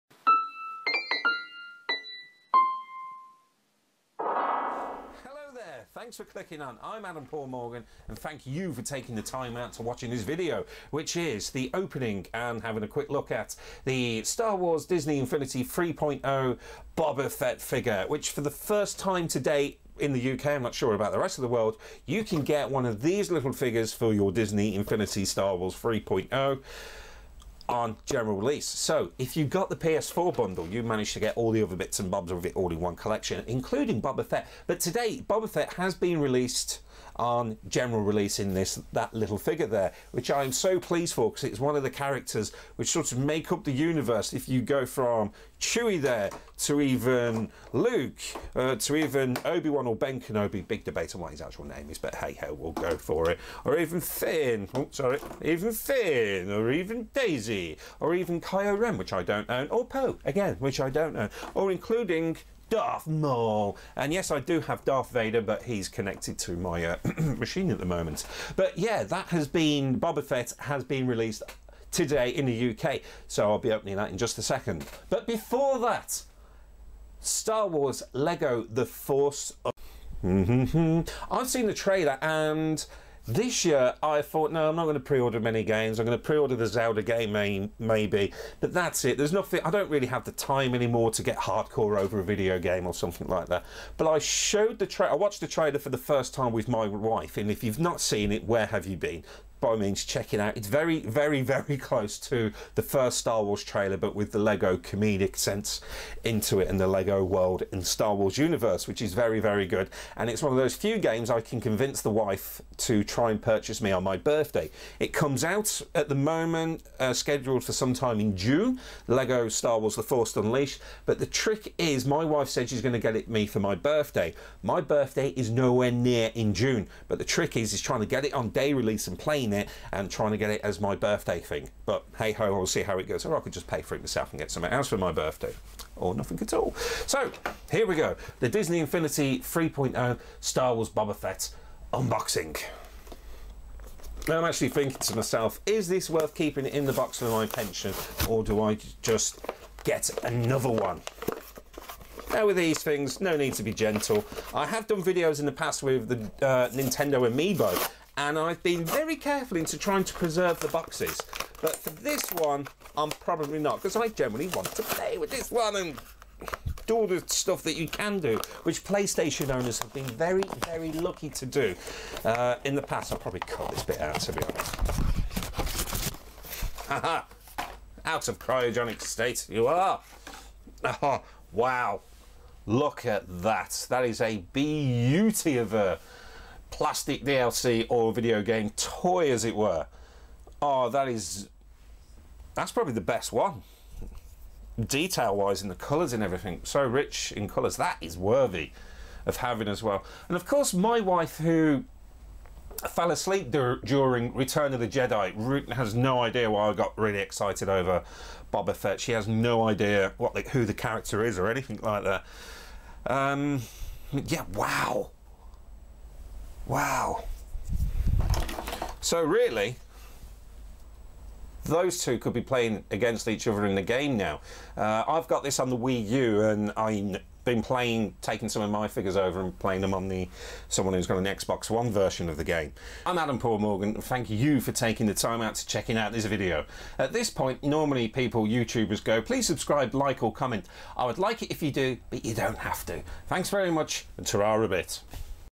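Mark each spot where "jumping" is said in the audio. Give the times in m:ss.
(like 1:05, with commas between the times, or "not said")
not said.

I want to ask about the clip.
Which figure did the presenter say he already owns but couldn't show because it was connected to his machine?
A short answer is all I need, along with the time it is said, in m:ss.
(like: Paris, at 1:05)
Darth Vader, at 1:04.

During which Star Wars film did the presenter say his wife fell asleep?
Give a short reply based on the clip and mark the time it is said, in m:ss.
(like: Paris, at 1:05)
Return of the Jedi, at 3:24.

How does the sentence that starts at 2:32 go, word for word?
Now with these things, no need to be gentle.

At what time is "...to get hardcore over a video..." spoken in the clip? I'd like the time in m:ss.
1:31.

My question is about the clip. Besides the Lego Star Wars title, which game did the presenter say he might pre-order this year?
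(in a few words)
Zelda.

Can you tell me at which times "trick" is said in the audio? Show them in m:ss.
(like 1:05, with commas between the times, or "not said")
2:01, 2:07.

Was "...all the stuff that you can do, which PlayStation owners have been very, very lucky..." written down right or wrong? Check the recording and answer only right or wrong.
right.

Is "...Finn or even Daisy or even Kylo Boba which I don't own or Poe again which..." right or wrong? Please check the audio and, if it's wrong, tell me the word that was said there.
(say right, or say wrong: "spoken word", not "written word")
wrong: "Ren", not "Boba".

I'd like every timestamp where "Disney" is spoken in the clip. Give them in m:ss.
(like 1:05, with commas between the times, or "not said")
0:14, 0:24, 2:18.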